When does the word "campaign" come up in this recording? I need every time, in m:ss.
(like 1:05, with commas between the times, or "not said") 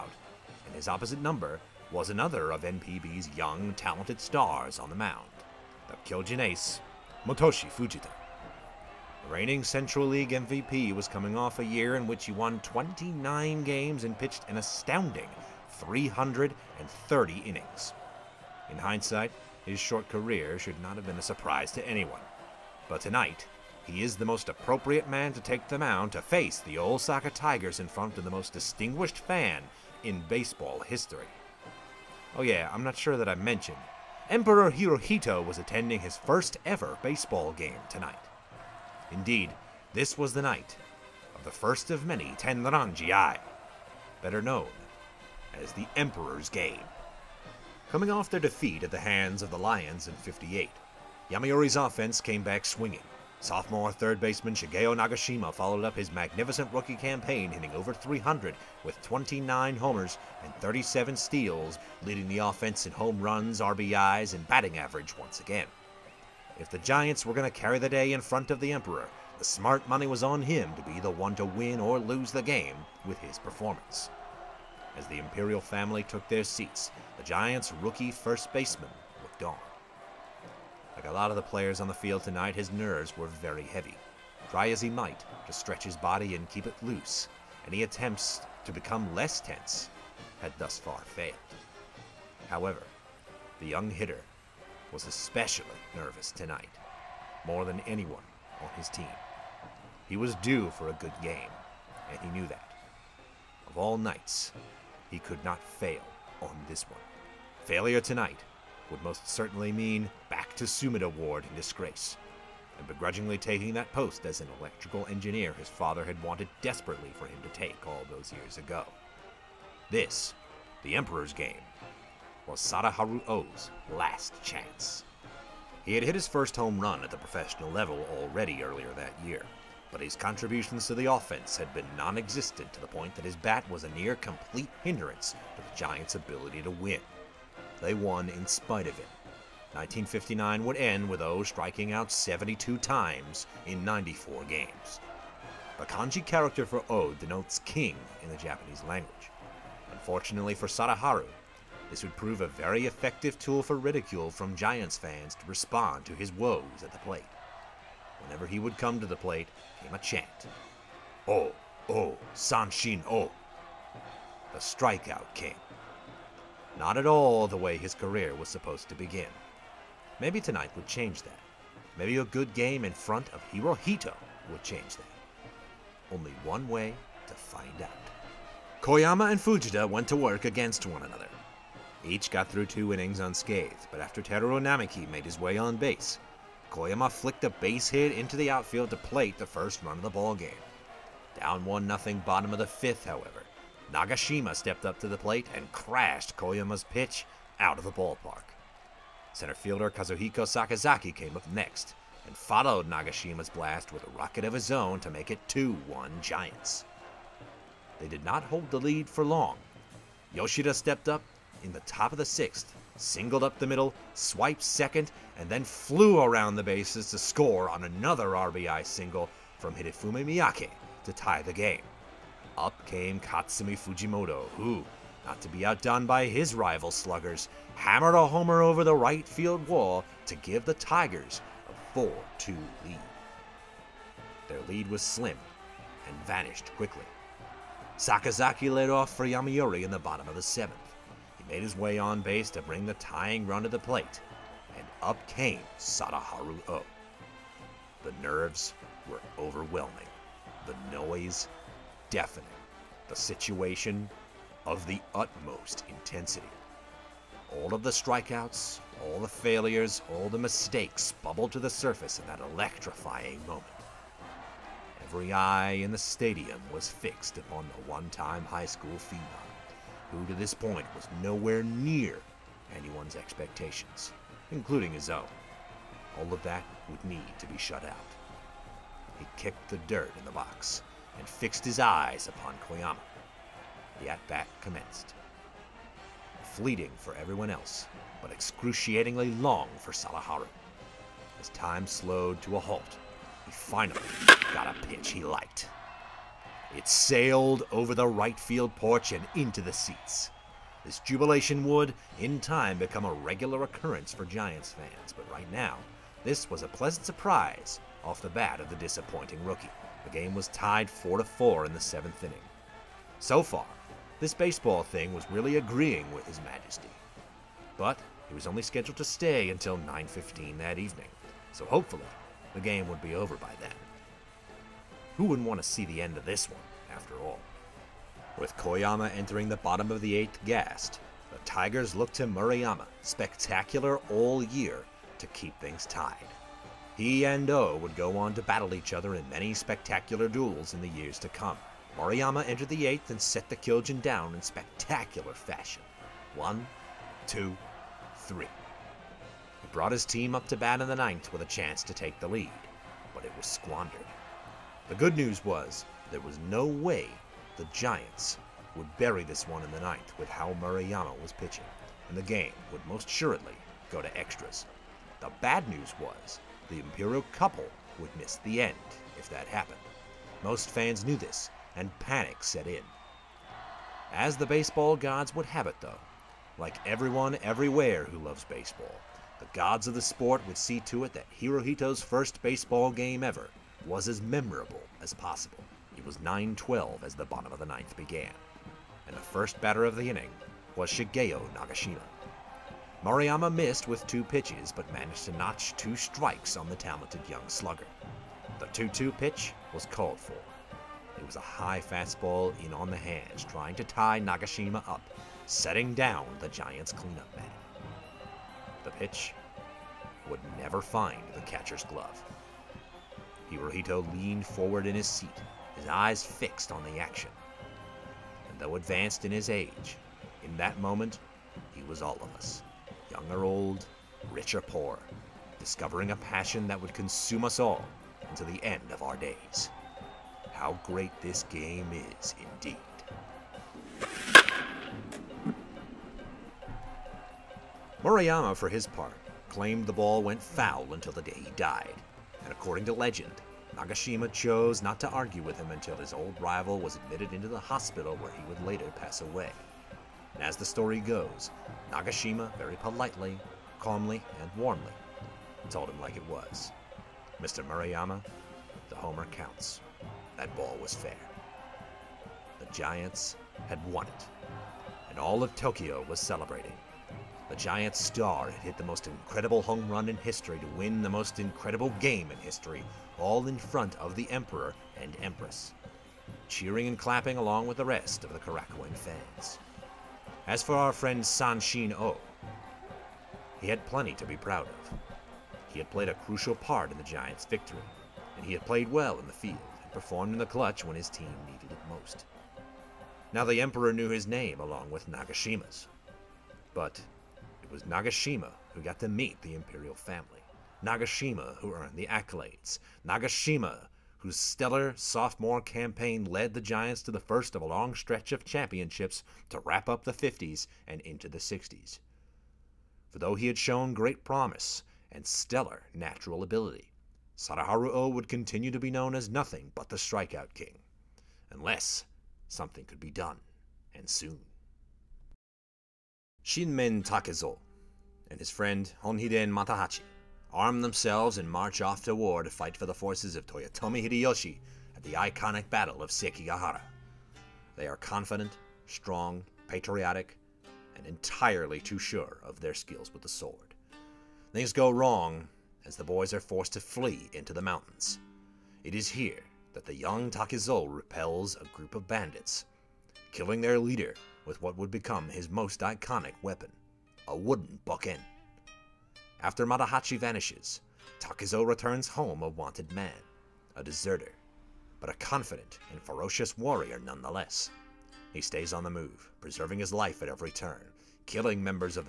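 0:56, 8:25.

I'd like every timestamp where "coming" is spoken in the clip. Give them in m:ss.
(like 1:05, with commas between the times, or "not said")
0:11, 0:47.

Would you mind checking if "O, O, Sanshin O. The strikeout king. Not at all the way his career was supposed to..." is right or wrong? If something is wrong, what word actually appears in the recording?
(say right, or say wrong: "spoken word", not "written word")
right.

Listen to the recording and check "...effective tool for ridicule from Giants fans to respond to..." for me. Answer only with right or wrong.
right.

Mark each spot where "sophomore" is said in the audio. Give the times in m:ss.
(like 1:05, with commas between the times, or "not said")
0:53, 8:24.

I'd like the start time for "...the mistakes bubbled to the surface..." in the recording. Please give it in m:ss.
4:20.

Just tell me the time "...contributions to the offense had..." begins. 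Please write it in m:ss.
2:10.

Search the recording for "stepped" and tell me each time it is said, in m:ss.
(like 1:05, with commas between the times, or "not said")
3:14, 3:30.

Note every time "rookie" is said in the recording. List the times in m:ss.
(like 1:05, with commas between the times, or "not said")
0:56, 1:17, 5:09.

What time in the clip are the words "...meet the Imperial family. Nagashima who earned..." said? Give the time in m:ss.
8:19.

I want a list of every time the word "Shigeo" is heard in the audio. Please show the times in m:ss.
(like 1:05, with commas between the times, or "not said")
0:54, 6:30.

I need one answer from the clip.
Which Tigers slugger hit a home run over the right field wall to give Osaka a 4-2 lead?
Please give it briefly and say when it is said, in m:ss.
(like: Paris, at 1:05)
Katsumi Fujimoto, at 3:43.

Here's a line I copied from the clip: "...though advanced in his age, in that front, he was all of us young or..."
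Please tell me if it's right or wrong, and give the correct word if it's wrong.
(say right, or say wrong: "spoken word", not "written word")
wrong: "moment", not "front".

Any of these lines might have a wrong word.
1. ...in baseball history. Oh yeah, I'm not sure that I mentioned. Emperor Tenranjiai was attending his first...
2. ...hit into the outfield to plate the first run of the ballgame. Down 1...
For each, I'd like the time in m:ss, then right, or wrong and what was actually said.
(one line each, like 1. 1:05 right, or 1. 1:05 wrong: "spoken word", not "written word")
1. 0:30 wrong: "Hirohito", not "Tenranjiai"
2. 3:07 right.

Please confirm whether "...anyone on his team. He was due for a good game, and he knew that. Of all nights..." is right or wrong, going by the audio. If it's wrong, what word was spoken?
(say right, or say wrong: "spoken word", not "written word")
right.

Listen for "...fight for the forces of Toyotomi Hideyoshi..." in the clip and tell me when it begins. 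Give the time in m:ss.
8:52.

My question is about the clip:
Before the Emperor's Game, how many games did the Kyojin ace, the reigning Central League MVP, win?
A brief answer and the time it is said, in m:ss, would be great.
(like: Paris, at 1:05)
29, at 0:12.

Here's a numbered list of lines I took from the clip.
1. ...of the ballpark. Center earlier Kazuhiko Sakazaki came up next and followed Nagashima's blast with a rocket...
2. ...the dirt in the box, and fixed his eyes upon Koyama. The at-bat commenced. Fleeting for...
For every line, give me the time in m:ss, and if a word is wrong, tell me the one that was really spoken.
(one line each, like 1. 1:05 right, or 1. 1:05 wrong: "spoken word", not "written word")
1. 3:17 wrong: "fielder", not "earlier"
2. 4:39 right.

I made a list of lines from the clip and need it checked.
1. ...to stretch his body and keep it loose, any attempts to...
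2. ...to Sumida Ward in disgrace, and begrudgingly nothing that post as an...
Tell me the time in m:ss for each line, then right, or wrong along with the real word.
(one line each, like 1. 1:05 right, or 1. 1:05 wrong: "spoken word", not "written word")
1. 1:25 right
2. 1:50 wrong: "taking", not "nothing".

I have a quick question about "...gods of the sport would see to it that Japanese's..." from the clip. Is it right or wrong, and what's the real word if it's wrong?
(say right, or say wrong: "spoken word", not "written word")
wrong: "Hirohito", not "Japanese".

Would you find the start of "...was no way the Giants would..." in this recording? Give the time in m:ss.
5:56.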